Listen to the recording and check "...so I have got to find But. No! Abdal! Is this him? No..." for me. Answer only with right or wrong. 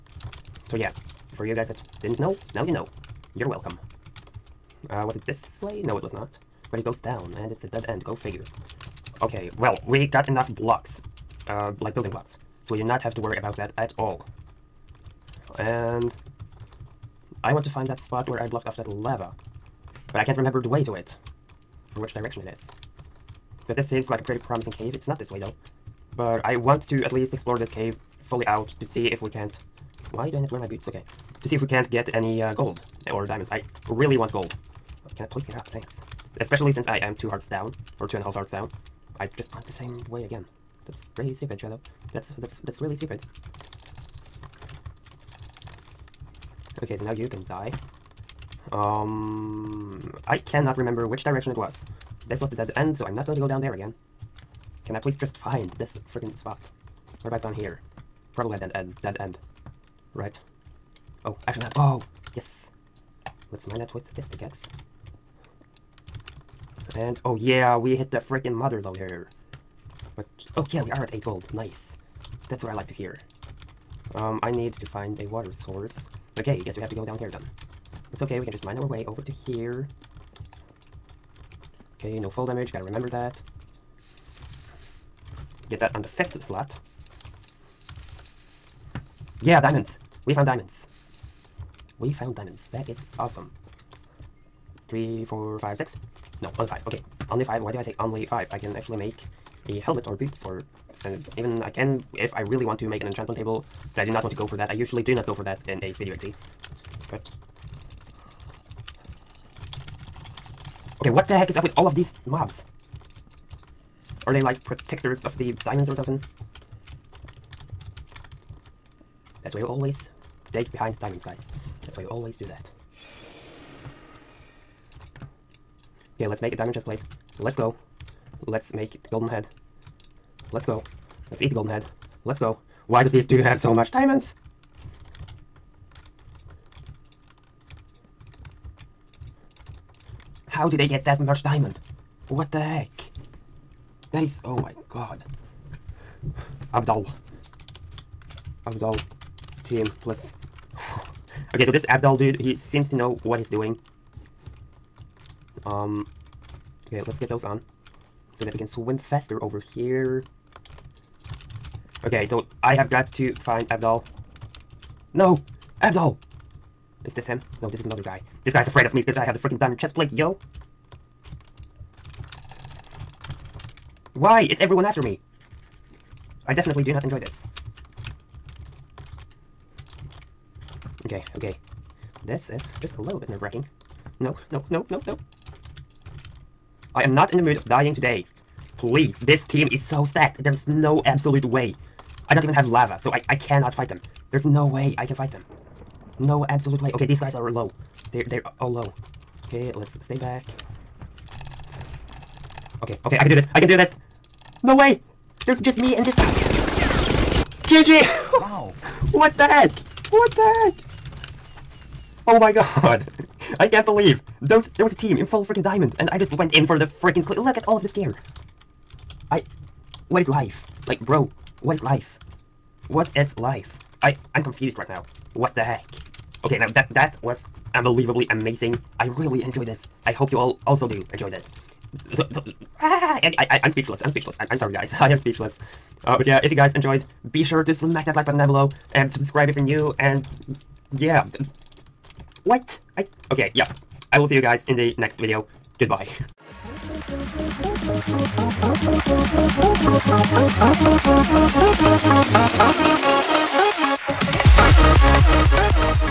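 wrong.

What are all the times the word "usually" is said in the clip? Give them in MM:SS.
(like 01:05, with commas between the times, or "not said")
01:44.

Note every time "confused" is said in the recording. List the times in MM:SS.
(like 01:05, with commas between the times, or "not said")
03:44.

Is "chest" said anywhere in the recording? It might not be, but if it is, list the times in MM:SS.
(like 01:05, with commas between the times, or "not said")
02:06, 02:49.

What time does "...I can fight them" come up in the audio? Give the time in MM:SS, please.
03:14.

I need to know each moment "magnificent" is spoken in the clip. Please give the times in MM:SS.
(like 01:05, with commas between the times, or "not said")
not said.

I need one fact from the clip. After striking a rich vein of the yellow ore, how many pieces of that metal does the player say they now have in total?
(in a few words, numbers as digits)
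8.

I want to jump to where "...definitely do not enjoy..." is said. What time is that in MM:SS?
02:56.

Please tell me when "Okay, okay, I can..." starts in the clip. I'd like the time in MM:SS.
03:22.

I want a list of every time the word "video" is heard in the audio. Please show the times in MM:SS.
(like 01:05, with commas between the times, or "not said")
01:45, 04:05.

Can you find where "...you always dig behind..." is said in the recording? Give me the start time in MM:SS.
01:59.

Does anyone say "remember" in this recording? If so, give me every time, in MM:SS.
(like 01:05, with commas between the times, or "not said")
00:20, 00:50, 01:22.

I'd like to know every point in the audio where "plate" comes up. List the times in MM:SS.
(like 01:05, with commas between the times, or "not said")
02:06, 02:49.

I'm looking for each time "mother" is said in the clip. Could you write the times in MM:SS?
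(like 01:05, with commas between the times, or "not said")
01:08.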